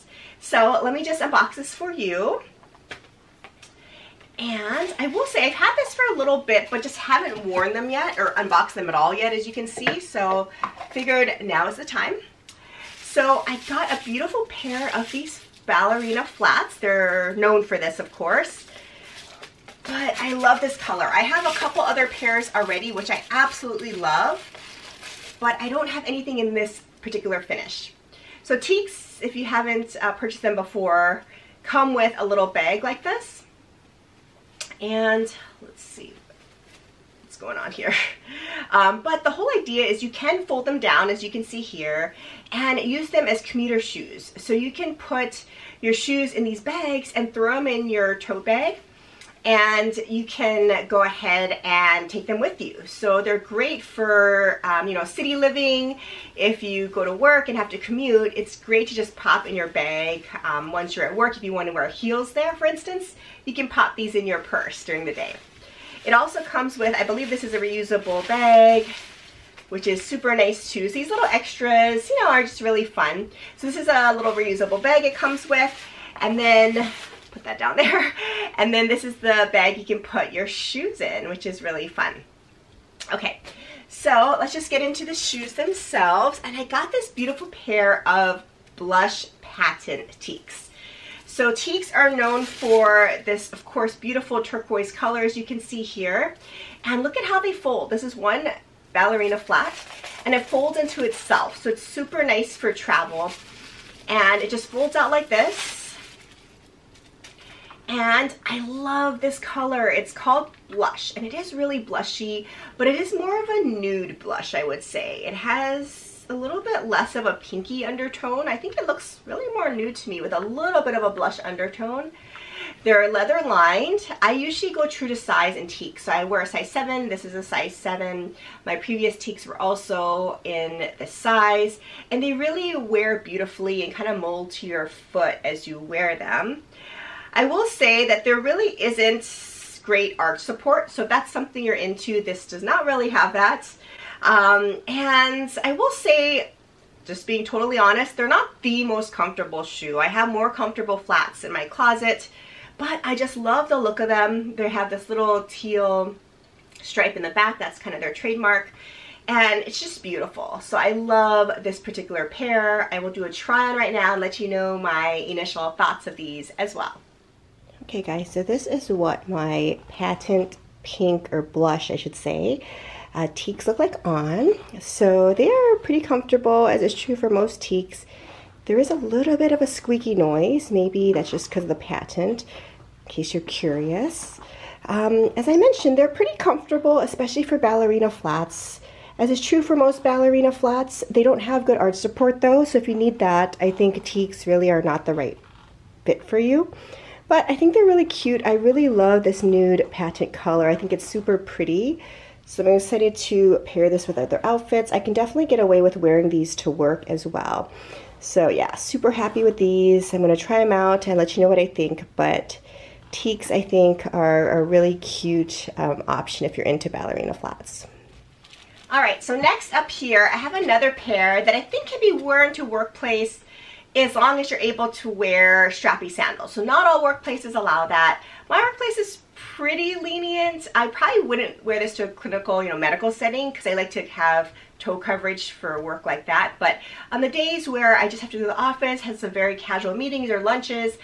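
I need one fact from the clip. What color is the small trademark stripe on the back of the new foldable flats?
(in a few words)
Teal.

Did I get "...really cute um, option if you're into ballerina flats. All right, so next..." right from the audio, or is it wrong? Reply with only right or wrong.
right.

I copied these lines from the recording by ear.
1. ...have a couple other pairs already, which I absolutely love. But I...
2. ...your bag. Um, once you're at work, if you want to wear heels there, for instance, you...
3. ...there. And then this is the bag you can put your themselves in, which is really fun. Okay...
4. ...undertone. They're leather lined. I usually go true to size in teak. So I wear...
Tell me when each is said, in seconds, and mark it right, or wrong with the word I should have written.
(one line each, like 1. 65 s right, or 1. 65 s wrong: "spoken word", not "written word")
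1. 21 s right
2. 59 s right
3. 77 s wrong: "shoes", not "themselves"
4. 121 s right.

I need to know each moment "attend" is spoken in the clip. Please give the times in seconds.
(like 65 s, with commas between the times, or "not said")
not said.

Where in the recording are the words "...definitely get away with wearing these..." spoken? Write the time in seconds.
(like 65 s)
205 s.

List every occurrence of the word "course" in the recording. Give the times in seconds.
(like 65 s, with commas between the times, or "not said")
18 s, 93 s.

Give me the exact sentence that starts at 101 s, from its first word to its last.
So it's super nice for travel.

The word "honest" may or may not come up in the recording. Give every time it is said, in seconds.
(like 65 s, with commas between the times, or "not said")
147 s.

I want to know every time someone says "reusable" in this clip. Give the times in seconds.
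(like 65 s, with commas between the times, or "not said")
67 s, 74 s.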